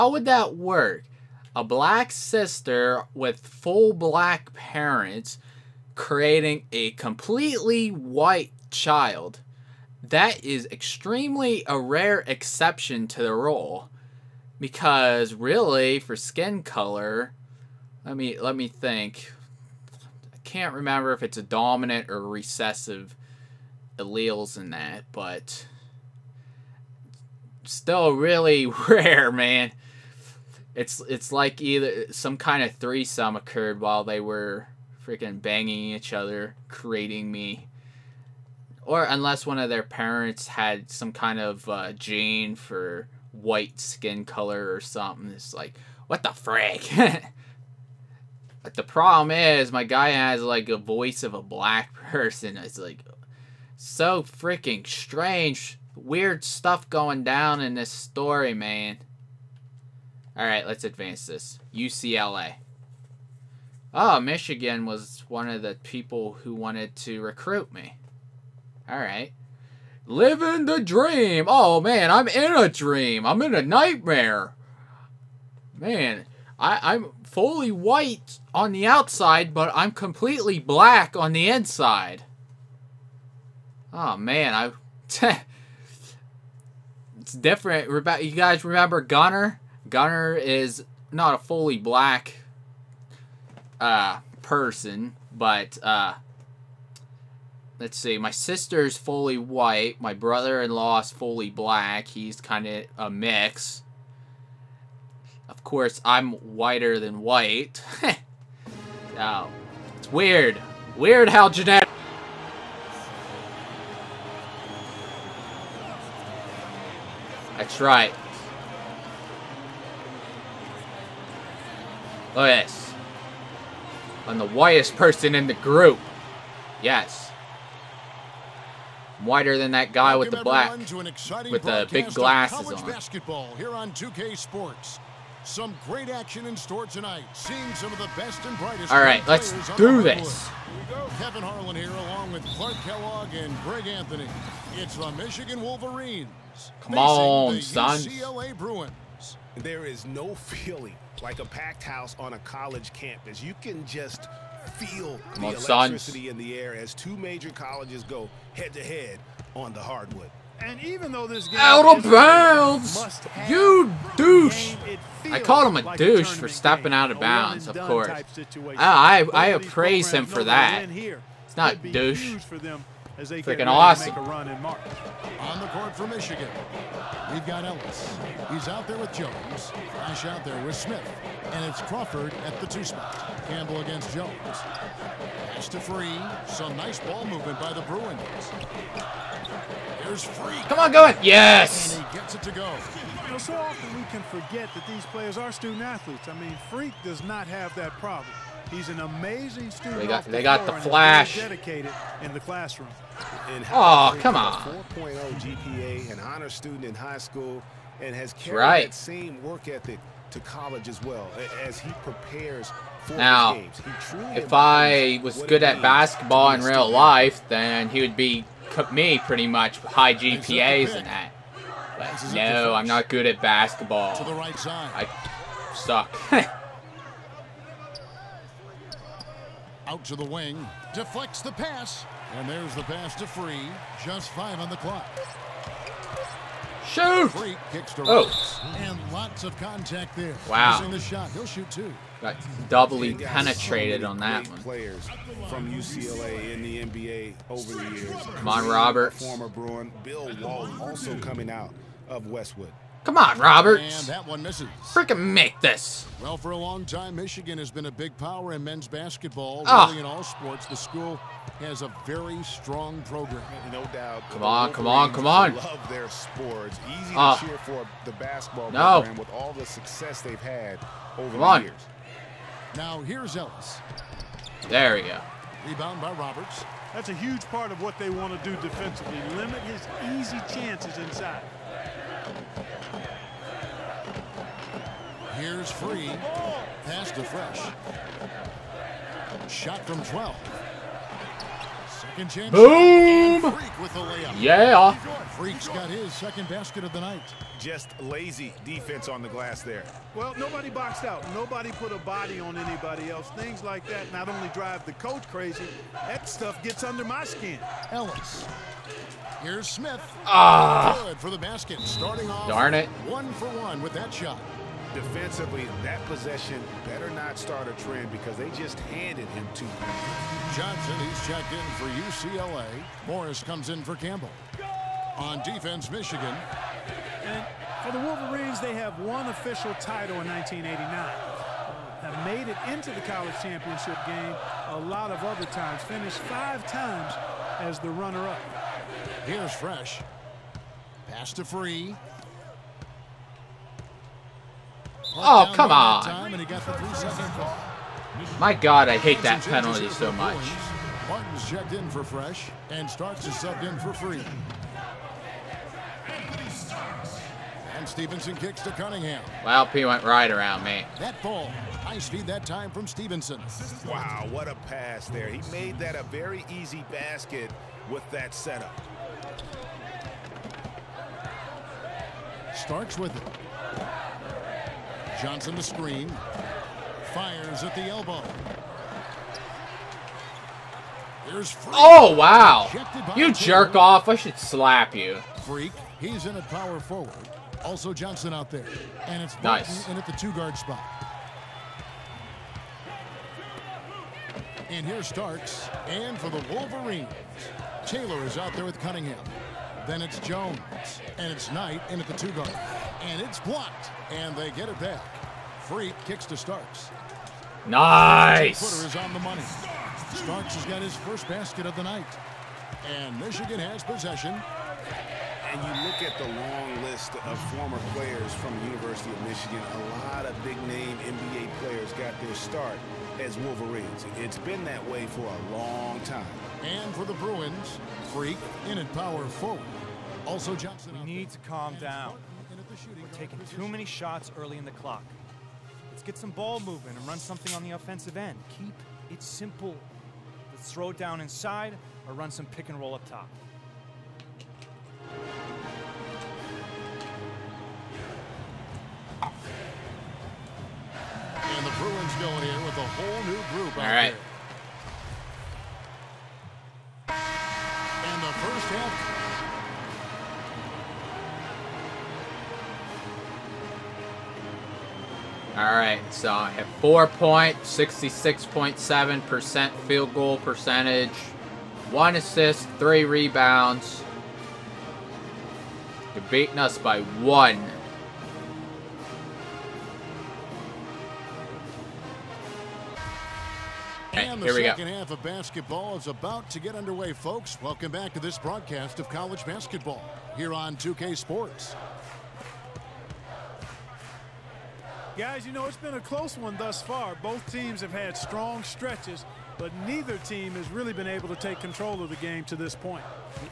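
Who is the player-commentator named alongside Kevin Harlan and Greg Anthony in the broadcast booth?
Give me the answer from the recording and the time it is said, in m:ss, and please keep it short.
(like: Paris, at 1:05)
Clark Kellogg, at 2:22.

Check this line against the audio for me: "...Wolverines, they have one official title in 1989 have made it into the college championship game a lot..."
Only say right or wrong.
right.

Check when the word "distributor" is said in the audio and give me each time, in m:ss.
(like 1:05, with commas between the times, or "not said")
not said.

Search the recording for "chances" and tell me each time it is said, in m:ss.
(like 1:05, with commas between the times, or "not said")
4:40, 4:52.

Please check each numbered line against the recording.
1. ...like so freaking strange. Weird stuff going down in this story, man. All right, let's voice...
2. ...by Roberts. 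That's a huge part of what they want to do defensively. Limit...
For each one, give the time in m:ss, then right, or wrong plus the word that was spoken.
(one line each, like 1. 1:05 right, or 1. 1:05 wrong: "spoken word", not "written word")
1. 0:52 wrong: "advance", not "voice"
2. 4:36 right.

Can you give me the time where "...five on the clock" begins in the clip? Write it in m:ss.
3:54.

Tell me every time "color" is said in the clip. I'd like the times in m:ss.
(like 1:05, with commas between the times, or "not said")
0:16, 0:44.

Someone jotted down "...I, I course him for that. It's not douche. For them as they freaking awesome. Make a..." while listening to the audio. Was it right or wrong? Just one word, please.
wrong.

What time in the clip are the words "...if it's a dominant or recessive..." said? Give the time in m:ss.
0:21.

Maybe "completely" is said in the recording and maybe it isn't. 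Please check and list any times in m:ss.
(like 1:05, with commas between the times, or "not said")
0:06, 1:19.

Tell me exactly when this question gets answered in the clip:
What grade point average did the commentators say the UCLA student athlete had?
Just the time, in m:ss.
3:24.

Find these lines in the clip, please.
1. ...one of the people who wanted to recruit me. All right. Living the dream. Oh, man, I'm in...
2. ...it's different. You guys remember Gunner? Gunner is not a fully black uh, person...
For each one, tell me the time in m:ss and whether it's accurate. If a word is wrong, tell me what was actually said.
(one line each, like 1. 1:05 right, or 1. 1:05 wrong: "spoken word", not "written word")
1. 1:05 right
2. 1:27 right.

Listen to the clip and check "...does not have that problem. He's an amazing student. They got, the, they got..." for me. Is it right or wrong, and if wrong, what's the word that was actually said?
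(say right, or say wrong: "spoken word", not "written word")
right.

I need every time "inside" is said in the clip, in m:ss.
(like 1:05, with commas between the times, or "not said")
1:21, 4:40, 7:21.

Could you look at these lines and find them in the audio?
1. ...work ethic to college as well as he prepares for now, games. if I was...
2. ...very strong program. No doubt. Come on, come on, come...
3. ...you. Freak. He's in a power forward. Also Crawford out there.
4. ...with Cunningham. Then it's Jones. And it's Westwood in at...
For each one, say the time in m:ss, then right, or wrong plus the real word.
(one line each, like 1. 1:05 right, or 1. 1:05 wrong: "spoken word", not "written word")
1. 3:29 right
2. 4:22 right
3. 6:24 wrong: "Johnson", not "Crawford"
4. 6:38 wrong: "Knight", not "Westwood".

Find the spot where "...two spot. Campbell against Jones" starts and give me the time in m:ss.
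3:02.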